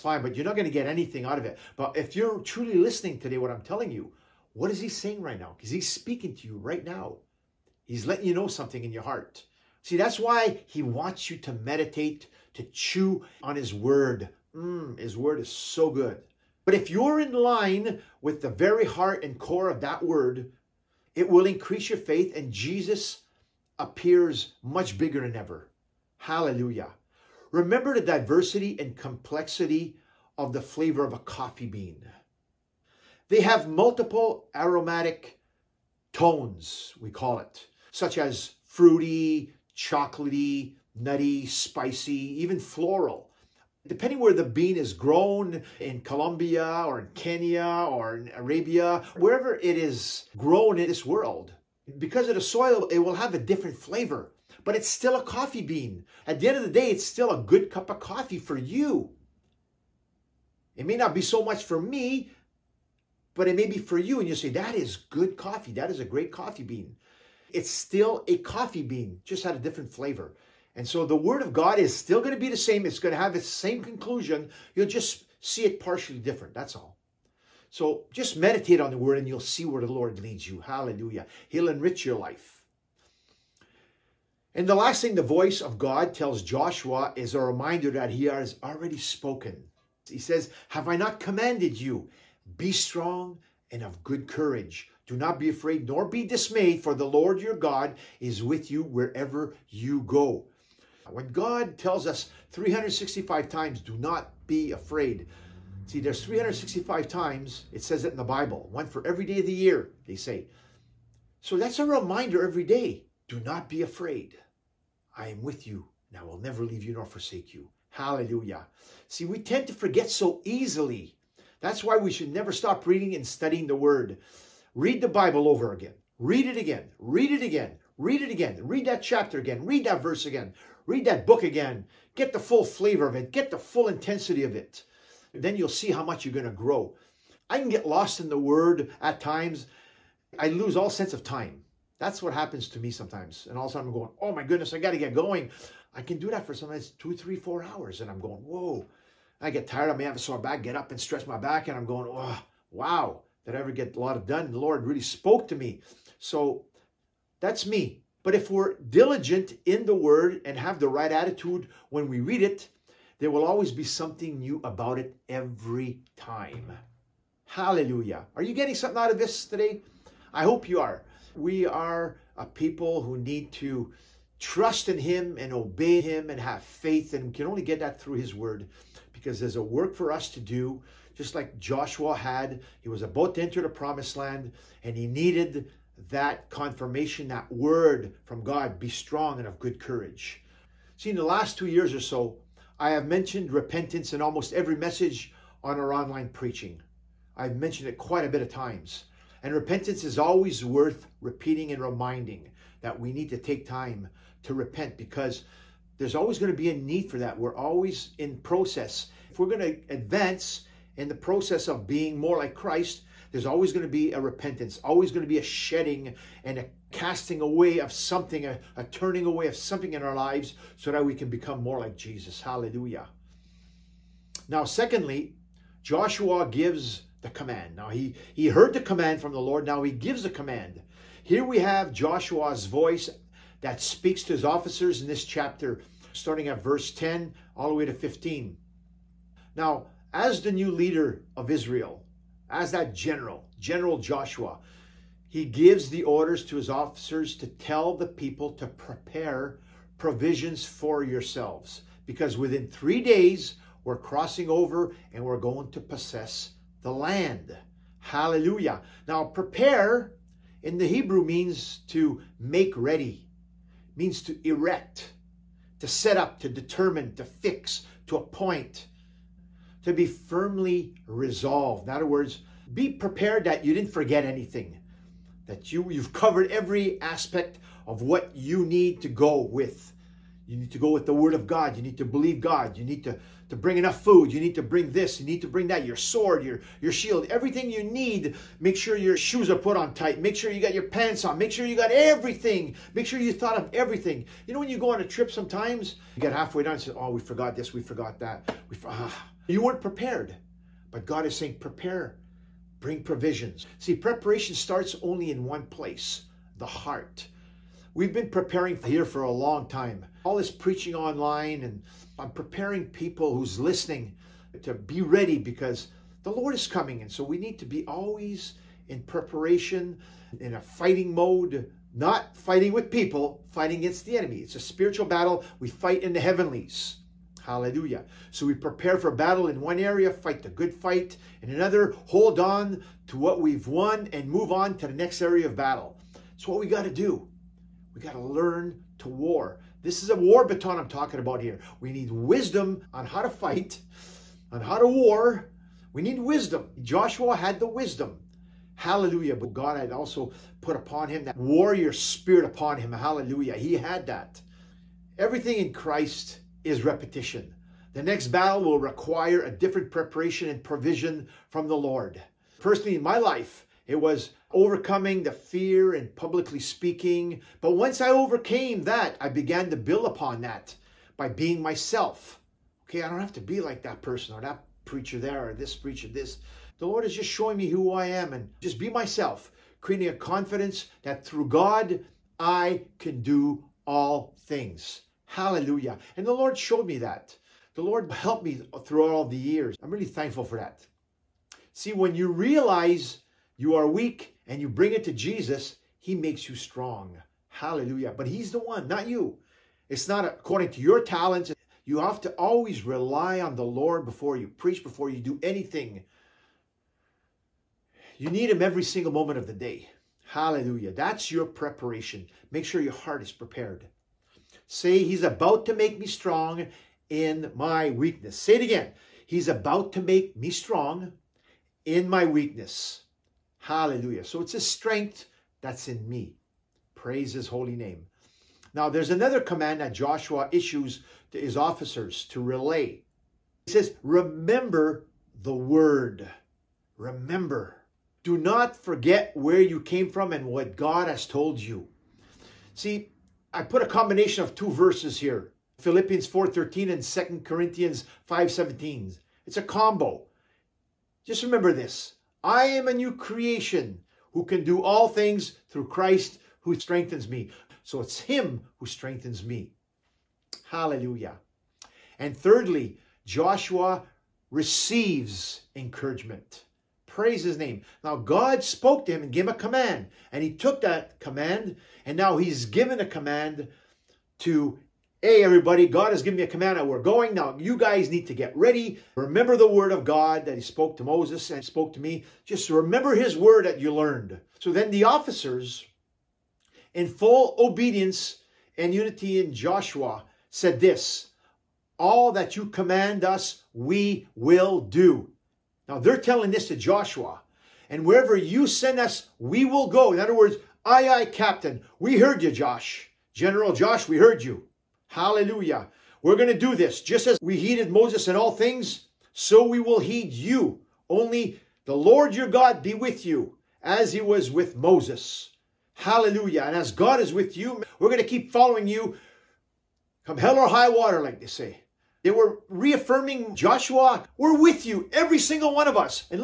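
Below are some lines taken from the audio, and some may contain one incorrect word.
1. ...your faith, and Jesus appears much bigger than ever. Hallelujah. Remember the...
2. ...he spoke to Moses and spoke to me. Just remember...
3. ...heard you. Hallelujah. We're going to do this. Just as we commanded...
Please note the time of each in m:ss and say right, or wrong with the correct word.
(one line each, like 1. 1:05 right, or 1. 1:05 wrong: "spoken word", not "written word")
1. 0:21 right
2. 8:00 right
3. 8:24 wrong: "heeded", not "commanded".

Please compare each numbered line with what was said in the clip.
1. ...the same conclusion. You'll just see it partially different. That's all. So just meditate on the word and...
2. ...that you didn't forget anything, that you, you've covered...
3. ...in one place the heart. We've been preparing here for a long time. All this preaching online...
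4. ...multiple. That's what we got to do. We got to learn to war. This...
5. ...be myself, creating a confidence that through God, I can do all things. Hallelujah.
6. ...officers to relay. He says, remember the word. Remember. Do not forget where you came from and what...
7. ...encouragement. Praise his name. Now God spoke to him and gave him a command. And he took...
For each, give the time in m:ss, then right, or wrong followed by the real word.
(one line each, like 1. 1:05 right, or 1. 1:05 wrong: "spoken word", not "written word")
1. 1:13 right
2. 4:33 right
3. 5:05 right
4. 5:35 wrong: "battle", not "multiple"
5. 6:18 right
6. 7:11 right
7. 7:45 right.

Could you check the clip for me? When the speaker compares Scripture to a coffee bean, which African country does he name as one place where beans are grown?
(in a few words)
Kenya.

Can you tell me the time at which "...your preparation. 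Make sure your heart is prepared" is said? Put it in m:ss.
6:51.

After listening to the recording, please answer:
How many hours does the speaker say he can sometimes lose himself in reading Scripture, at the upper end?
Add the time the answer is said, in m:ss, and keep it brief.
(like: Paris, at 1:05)
4, at 2:27.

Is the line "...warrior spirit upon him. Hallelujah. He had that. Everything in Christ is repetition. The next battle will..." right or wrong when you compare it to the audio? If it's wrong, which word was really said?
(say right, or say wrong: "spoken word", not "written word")
right.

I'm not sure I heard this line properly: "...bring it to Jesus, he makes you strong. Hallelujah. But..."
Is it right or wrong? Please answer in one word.
right.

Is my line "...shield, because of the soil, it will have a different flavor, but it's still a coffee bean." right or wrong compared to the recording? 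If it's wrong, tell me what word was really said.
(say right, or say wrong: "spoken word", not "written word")
wrong: "world", not "shield".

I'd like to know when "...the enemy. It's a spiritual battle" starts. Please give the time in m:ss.
5:24.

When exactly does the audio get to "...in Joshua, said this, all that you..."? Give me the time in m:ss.
8:09.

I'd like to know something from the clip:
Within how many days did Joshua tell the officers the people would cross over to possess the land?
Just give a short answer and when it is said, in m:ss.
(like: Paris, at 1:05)
3, at 4:12.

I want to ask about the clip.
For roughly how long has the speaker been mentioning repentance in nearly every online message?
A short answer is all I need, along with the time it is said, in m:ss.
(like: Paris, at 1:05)
2 years, at 3:11.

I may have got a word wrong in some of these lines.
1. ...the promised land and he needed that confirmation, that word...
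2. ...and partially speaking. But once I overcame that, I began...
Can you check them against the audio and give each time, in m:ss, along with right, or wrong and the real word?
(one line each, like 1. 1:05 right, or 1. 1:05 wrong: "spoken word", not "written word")
1. 3:03 right
2. 6:05 wrong: "publicly", not "partially".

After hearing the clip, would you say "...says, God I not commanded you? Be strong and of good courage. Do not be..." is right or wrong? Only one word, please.
wrong.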